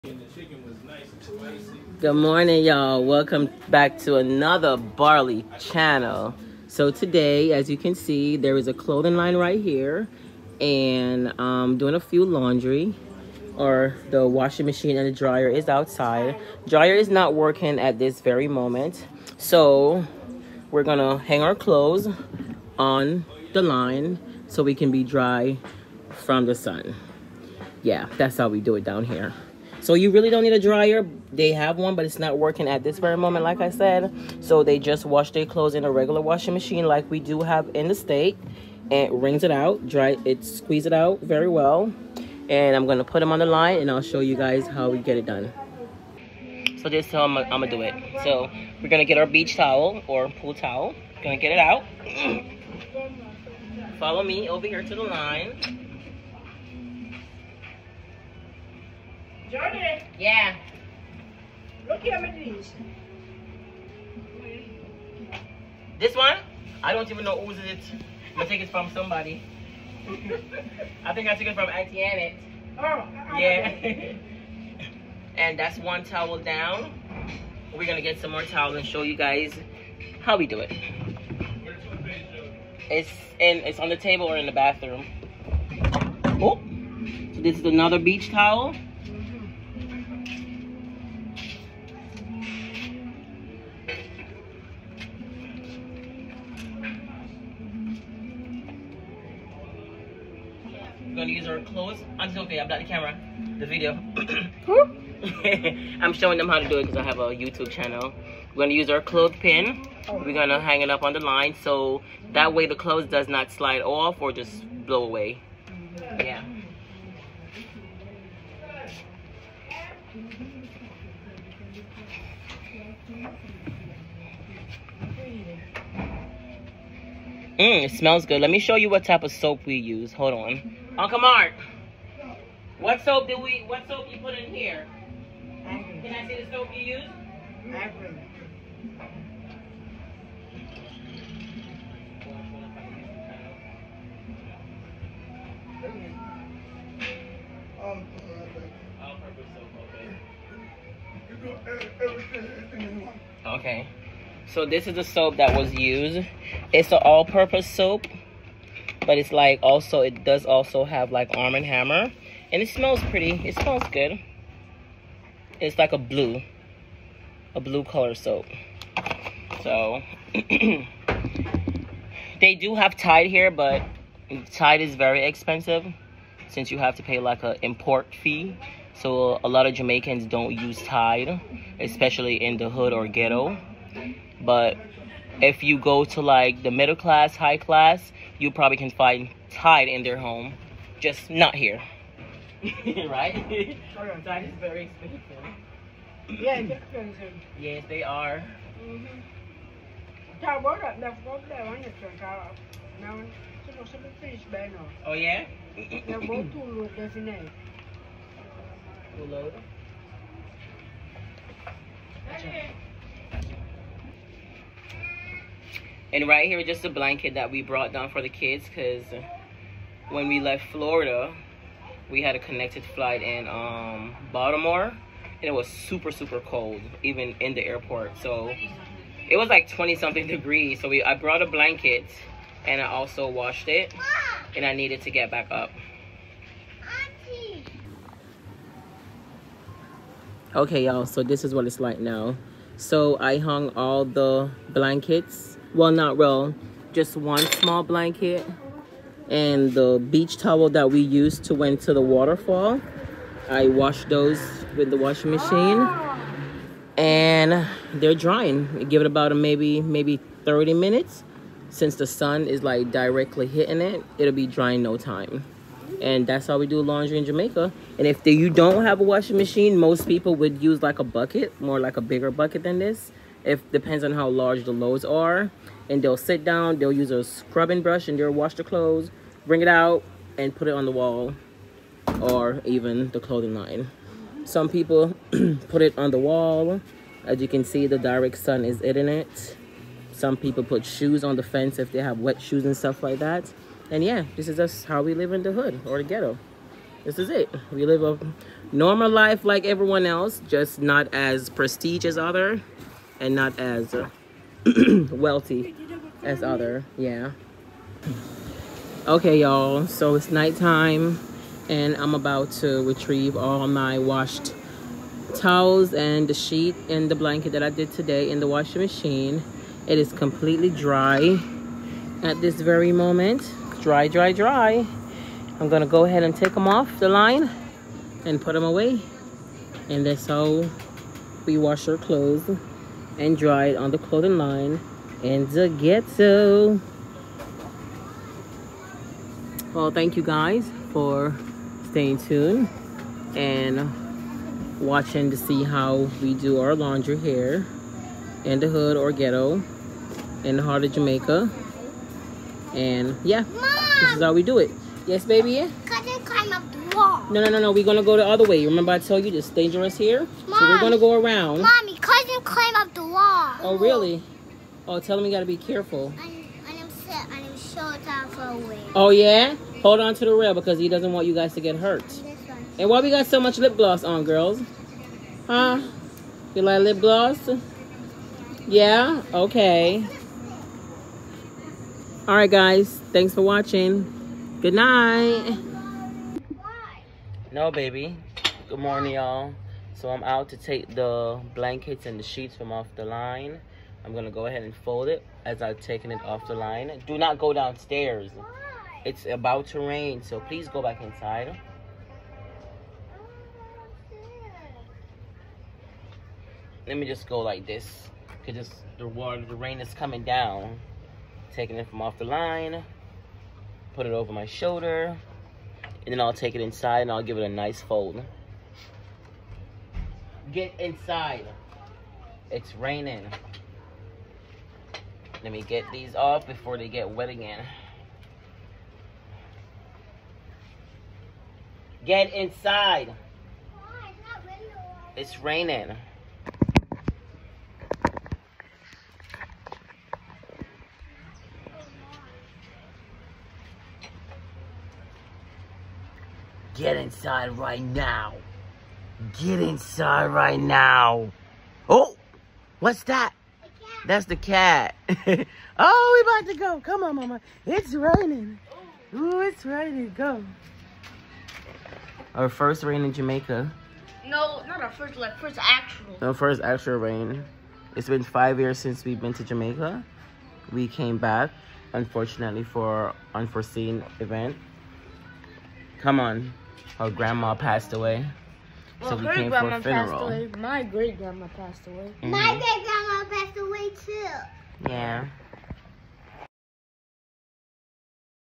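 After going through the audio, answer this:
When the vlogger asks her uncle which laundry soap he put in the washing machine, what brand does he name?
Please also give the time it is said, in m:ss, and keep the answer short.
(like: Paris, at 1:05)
Ivory, at 2:17.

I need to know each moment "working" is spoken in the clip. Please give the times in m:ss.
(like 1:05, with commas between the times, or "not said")
0:17, 0:32.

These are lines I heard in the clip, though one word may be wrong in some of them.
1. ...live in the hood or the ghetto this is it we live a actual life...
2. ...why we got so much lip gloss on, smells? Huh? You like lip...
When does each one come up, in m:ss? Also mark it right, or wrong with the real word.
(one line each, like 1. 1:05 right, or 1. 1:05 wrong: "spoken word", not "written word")
1. 4:55 wrong: "normal", not "actual"
2. 6:12 wrong: "girls", not "smells".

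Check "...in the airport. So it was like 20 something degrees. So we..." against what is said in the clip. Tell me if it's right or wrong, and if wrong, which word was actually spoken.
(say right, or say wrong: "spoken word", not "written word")
right.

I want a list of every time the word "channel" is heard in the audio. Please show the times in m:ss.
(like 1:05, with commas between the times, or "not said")
0:05, 1:47.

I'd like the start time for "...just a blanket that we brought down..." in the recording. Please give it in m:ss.
3:36.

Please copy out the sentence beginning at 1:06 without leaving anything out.
I don't even know who's it.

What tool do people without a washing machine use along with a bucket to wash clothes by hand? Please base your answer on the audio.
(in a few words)
scrubbing brush.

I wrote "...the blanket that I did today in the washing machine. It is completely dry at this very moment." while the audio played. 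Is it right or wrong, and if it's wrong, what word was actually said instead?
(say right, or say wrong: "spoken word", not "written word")
right.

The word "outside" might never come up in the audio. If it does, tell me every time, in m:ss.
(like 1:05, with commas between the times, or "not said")
0:15.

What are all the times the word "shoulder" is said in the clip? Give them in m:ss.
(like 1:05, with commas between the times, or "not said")
6:54.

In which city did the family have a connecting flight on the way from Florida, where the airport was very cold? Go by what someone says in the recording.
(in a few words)
Baltimore.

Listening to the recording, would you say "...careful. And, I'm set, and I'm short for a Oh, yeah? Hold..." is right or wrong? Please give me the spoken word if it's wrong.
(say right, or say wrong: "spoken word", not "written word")
right.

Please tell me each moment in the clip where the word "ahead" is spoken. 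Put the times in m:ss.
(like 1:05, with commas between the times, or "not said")
5:26, 6:34.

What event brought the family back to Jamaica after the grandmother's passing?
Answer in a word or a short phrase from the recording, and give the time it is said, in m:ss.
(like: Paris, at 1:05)
a funeral, at 7:59.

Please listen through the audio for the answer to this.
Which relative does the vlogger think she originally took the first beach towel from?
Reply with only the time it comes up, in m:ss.
1:11.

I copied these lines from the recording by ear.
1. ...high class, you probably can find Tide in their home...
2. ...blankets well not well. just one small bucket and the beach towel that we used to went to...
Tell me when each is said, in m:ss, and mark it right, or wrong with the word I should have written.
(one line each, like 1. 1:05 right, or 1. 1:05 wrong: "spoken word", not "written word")
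1. 3:07 right
2. 4:04 wrong: "blanket", not "bucket".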